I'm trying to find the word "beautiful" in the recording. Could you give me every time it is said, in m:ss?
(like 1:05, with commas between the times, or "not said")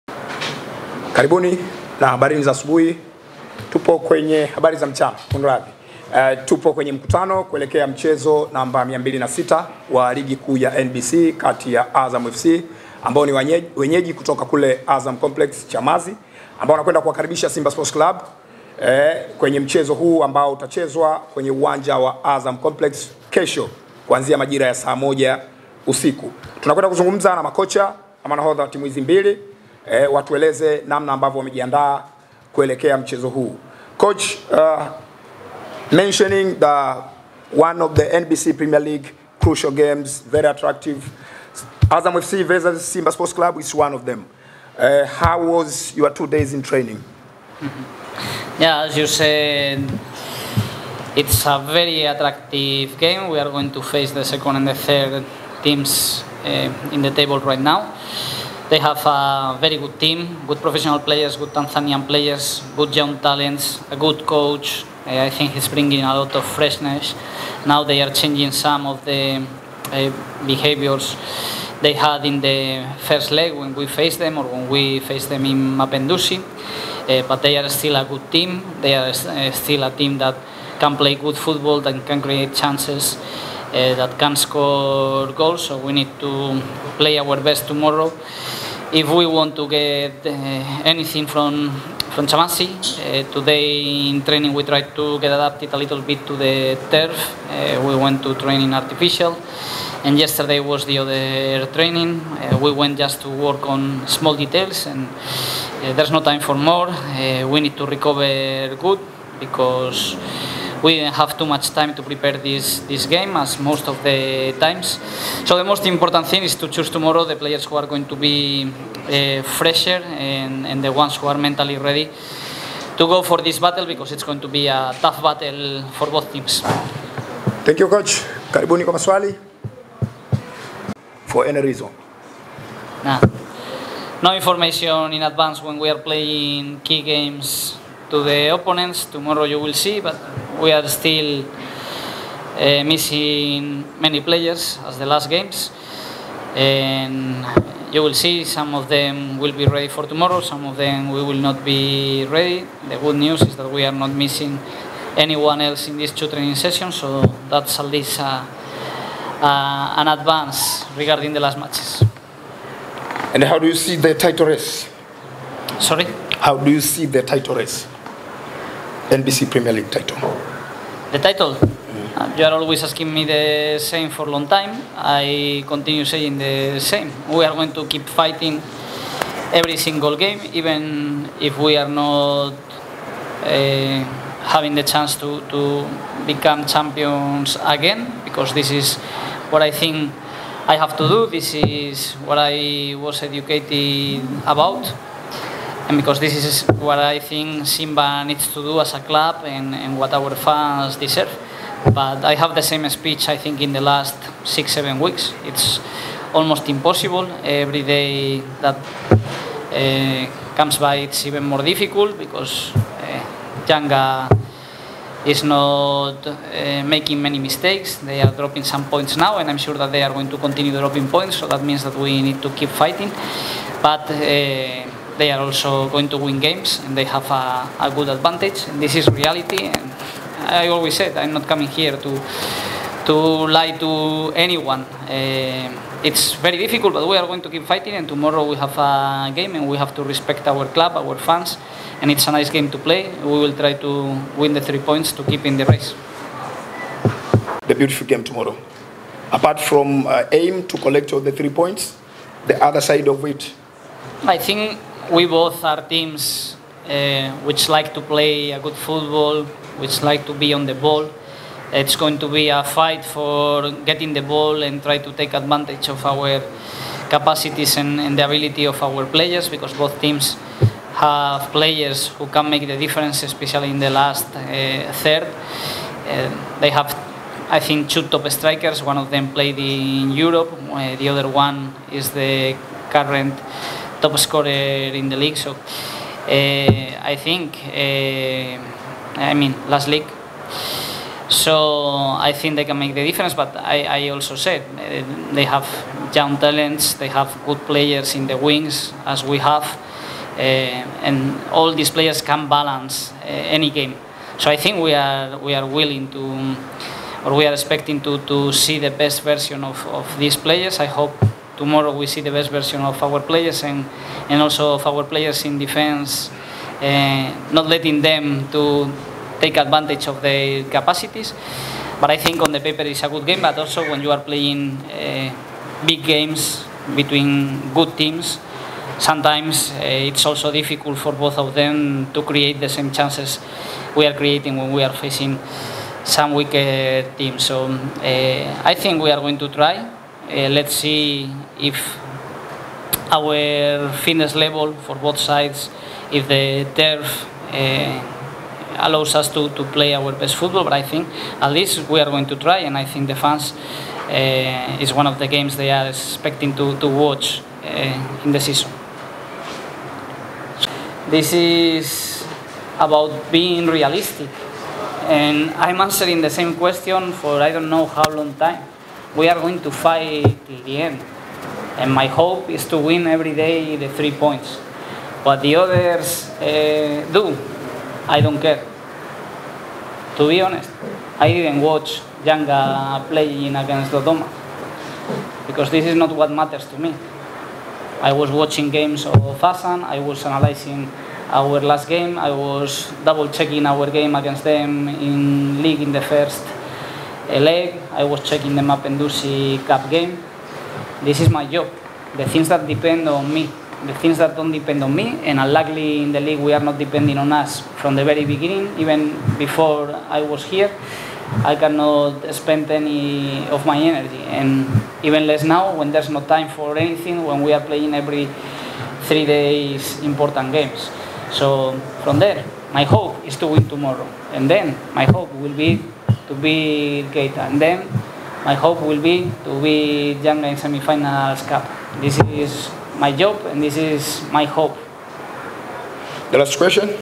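4:07.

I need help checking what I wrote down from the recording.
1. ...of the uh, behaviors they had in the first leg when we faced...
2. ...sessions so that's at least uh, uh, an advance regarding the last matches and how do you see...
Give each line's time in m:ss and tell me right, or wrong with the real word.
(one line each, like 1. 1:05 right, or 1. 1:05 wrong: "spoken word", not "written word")
1. 1:08 right
2. 2:36 right.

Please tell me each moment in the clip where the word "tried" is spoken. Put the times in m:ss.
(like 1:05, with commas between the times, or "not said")
1:34.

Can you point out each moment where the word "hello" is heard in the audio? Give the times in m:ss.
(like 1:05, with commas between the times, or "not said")
not said.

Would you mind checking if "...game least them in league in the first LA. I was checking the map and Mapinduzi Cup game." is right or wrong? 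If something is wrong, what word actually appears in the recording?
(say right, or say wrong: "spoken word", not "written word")
wrong: "against", not "least".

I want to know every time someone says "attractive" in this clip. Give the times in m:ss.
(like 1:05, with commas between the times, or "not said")
0:40, 0:52.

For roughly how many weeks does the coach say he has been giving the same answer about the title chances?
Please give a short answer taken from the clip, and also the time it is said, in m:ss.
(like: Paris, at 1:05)
six, seven weeks, at 3:24.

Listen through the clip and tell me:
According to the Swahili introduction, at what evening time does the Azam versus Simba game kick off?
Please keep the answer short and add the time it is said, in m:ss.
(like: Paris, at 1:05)
saa moja usiku, at 0:24.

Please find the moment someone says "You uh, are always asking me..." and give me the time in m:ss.
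2:52.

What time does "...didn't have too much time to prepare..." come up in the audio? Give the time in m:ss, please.
1:50.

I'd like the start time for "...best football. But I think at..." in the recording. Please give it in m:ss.
5:50.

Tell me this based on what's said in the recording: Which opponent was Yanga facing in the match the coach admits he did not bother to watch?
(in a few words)
Dodoma.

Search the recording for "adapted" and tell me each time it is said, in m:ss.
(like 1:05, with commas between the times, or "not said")
1:35.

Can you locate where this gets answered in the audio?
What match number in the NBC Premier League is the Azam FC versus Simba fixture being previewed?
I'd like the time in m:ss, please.
0:08.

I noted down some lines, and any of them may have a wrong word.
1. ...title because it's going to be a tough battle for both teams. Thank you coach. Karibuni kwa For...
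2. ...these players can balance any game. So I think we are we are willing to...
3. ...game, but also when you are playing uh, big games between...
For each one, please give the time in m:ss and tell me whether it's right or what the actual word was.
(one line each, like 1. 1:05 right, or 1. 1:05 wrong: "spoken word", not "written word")
1. 2:03 wrong: "battle", not "title"
2. 5:01 right
3. 5:23 right.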